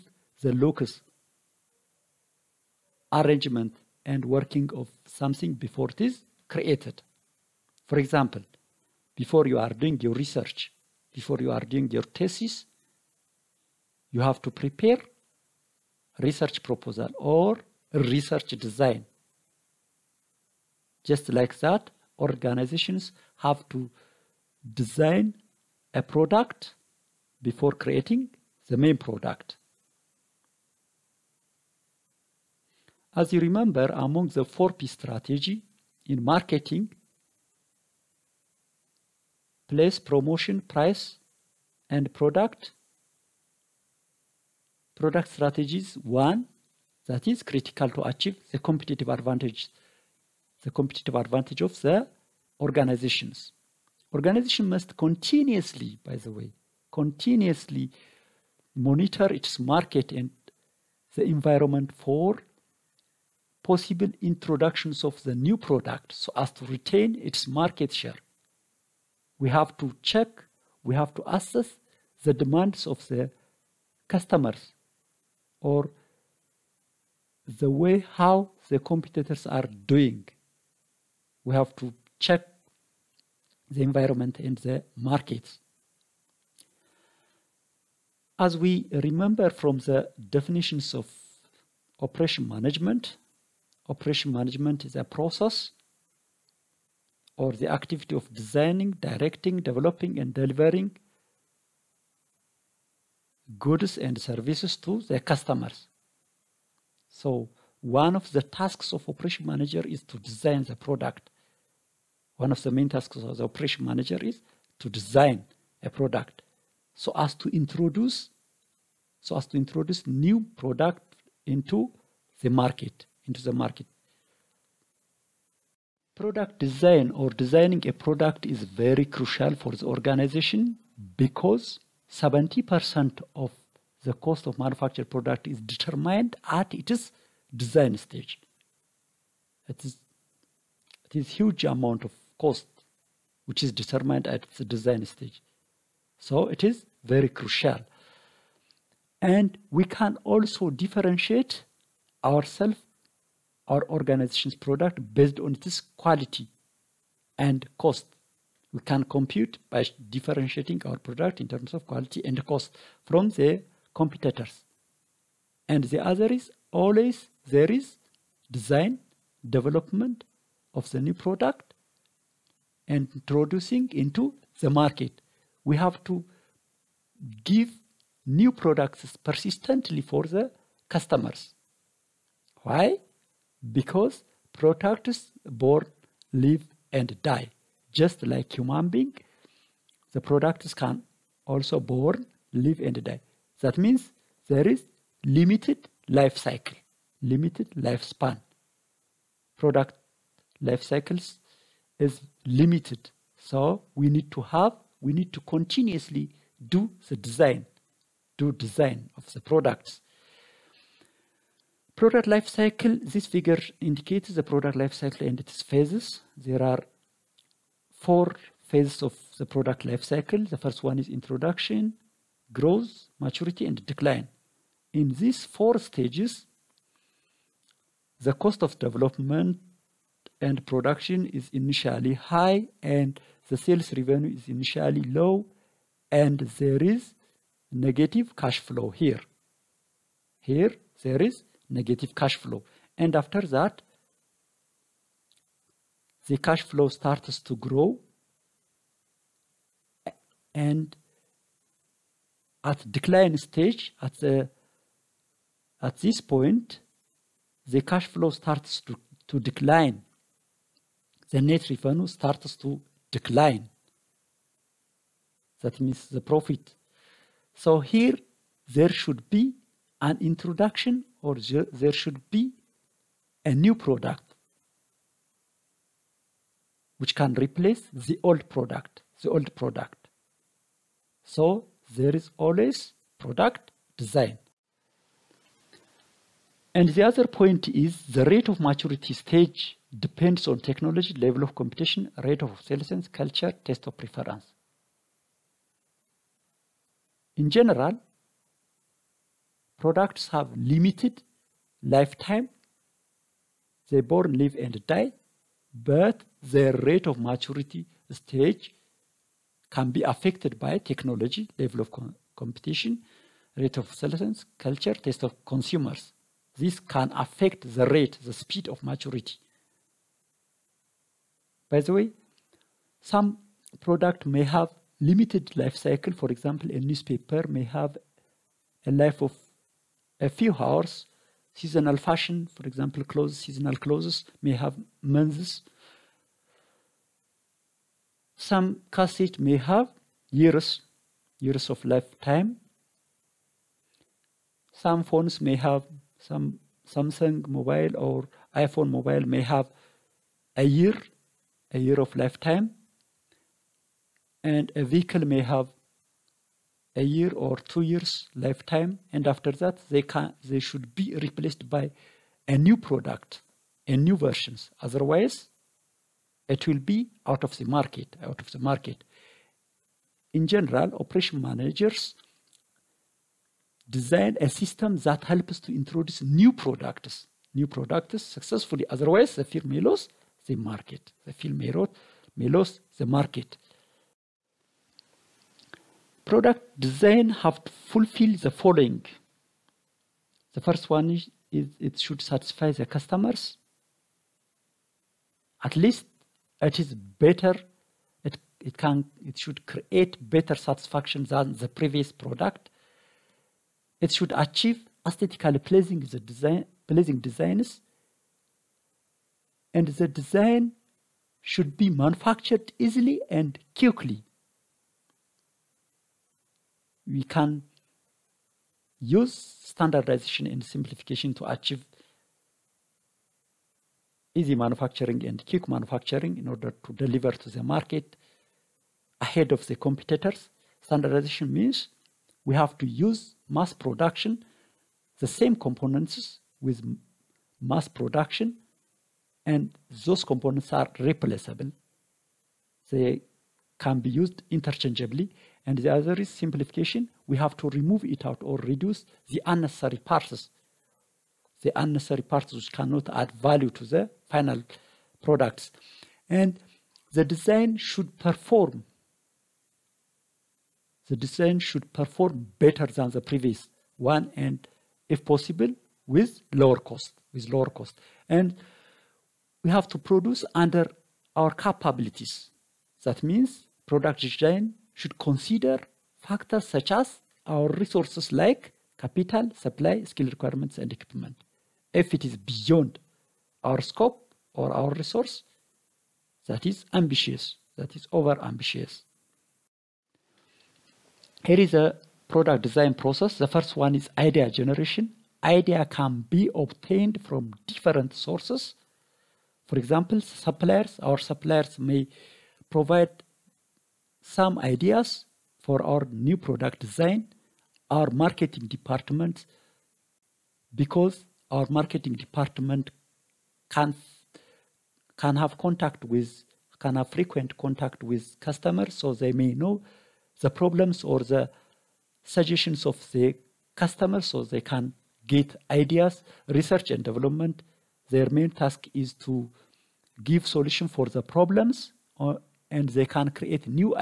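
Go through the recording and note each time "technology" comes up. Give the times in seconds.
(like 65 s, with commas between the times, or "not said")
290 s, 310 s.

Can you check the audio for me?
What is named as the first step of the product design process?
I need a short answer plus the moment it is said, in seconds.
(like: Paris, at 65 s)
Idea generation, at 494 s.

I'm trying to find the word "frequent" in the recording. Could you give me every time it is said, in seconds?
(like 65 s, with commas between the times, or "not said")
517 s.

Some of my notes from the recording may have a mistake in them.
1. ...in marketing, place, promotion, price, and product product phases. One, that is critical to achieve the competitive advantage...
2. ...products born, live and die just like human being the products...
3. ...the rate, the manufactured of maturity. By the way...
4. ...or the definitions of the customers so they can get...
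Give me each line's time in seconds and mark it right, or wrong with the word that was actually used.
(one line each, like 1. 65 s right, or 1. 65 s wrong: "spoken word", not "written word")
1. 36 s wrong: "strategies", not "phases"
2. 184 s right
3. 317 s wrong: "speed", not "manufactured"
4. 521 s wrong: "suggestions", not "definitions".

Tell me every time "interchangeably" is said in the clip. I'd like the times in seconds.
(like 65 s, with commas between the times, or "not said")
444 s.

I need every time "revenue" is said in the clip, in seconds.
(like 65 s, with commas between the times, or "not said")
233 s, 261 s.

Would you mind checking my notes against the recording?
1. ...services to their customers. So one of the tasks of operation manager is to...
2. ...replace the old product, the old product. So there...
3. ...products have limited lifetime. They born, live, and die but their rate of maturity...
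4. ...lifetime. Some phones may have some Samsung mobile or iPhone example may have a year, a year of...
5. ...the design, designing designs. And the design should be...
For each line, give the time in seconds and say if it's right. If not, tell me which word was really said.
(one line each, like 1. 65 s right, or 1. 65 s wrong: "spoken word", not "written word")
1. 104 s right
2. 277 s right
3. 299 s right
4. 341 s wrong: "mobile", not "example"
5. 406 s wrong: "pleasing", not "designing".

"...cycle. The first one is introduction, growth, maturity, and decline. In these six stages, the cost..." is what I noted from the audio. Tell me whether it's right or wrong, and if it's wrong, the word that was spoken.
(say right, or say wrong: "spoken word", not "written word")
wrong: "four", not "six".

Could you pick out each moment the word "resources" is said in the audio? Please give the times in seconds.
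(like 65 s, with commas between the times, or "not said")
477 s, 484 s.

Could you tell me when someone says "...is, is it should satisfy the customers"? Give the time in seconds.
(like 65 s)
391 s.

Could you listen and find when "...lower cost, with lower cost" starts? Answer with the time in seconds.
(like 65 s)
466 s.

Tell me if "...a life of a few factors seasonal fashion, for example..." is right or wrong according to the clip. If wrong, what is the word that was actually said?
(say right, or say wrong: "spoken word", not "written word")
wrong: "hours", not "factors".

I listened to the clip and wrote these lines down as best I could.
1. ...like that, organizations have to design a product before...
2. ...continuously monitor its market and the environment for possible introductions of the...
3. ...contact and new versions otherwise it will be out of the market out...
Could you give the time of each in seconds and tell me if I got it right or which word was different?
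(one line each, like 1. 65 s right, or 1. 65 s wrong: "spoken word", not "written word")
1. 21 s right
2. 56 s right
3. 362 s wrong: "product", not "contact".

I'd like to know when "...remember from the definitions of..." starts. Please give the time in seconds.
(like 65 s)
88 s.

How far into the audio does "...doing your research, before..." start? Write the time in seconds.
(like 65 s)
9 s.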